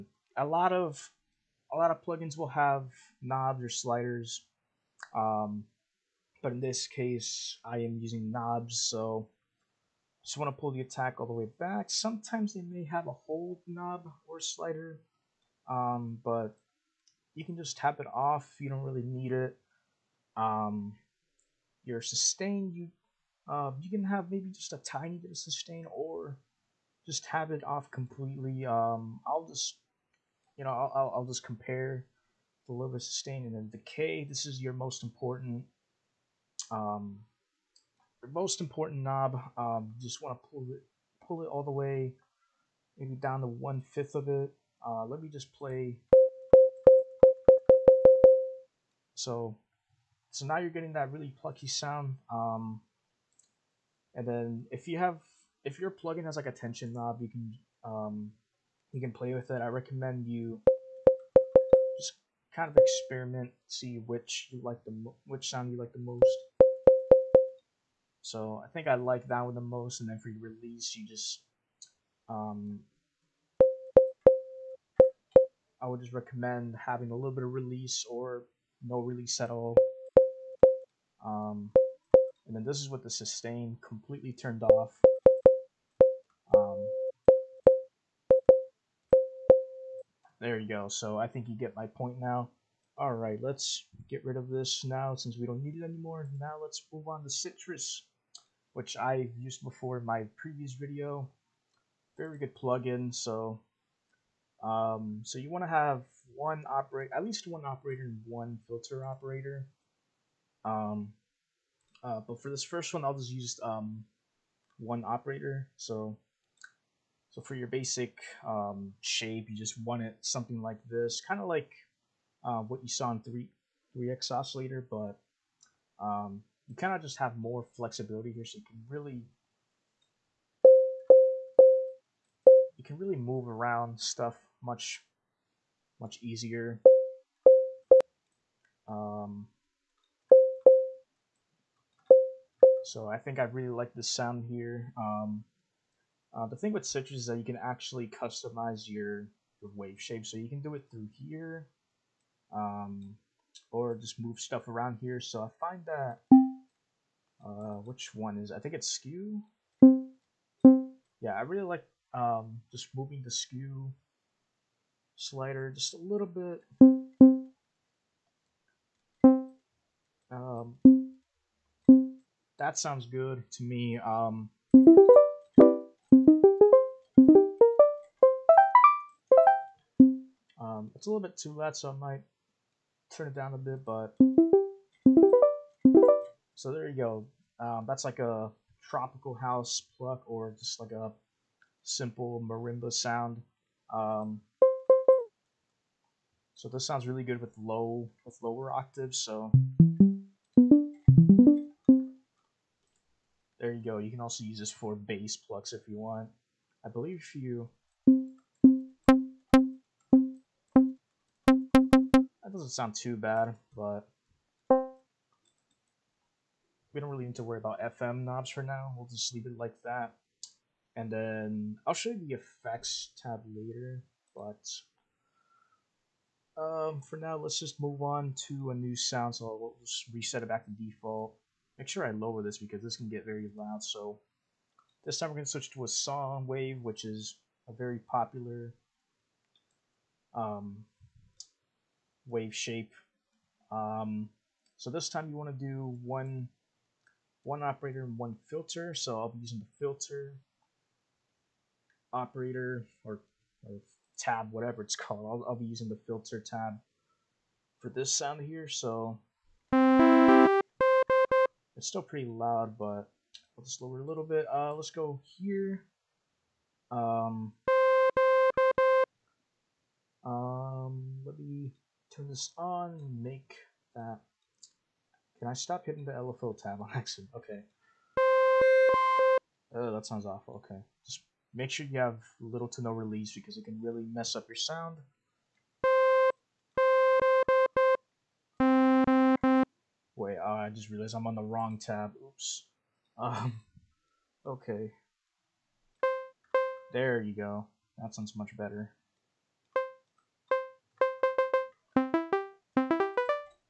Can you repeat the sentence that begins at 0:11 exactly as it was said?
Sometimes they may have a hold knob or slider, um, but you can just tap it off.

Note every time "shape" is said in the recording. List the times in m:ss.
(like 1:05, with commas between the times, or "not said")
1:59, 2:30, 4:02.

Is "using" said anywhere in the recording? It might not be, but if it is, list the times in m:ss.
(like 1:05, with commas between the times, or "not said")
0:08, 4:09, 4:15.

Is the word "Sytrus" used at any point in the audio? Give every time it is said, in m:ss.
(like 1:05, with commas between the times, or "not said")
1:37, 2:26.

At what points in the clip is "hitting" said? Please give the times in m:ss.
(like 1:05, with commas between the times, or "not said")
4:35.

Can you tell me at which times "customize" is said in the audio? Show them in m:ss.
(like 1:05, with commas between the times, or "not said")
2:28.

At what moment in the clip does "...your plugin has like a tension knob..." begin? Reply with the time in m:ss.
0:55.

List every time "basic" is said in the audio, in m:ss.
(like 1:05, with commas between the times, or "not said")
1:57.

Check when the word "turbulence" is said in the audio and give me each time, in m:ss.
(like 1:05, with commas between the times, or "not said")
not said.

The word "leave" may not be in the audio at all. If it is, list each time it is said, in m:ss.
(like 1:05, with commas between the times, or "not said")
3:39.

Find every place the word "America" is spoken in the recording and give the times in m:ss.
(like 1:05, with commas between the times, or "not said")
not said.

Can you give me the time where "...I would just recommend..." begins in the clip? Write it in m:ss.
1:15.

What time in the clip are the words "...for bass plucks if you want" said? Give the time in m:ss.
3:24.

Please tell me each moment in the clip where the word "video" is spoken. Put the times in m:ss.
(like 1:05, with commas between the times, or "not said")
1:40.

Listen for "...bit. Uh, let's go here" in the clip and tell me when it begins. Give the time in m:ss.
4:24.